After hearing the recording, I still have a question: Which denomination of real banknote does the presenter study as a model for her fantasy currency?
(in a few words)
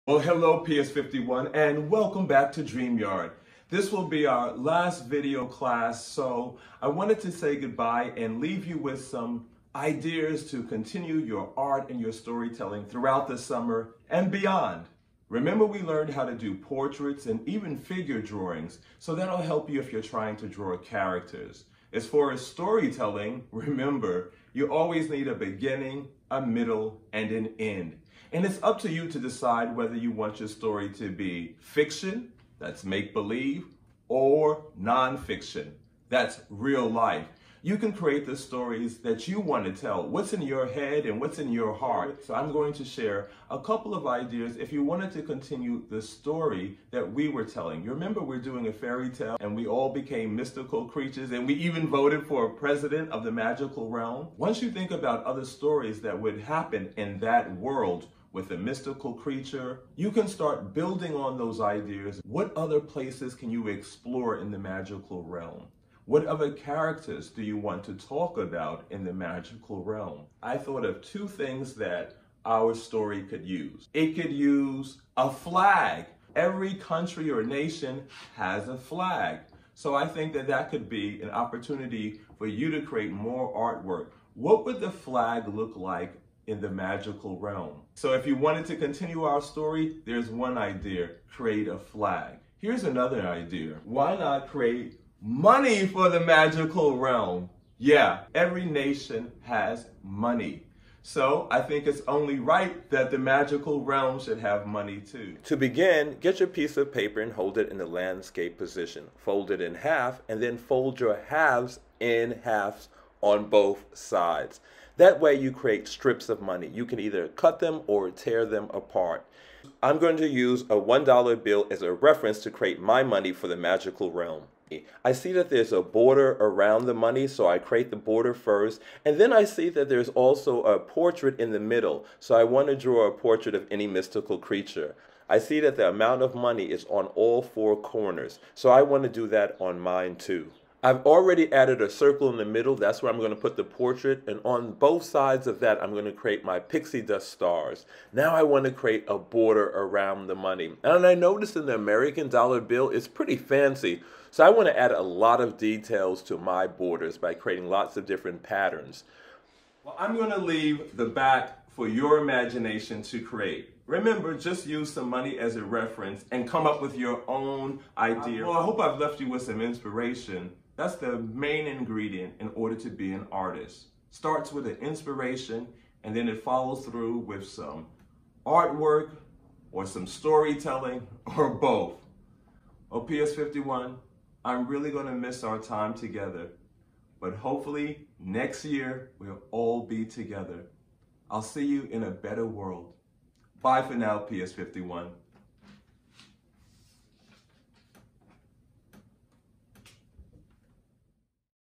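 $1 bill.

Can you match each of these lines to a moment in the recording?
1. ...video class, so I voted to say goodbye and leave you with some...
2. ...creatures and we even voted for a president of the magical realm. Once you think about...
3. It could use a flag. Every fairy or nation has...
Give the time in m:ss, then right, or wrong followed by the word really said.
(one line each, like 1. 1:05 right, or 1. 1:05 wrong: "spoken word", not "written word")
1. 0:05 wrong: "wanted", not "voted"
2. 0:50 right
3. 1:13 wrong: "country", not "fairy".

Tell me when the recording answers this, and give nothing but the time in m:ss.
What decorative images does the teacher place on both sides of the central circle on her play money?
2:26.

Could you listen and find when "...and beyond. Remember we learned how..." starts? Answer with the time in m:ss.
0:14.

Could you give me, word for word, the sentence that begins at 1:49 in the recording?
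Fold it in half and then fold your halves in halves on both sides.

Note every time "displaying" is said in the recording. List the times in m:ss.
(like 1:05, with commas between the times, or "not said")
not said.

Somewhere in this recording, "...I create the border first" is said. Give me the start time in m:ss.
2:07.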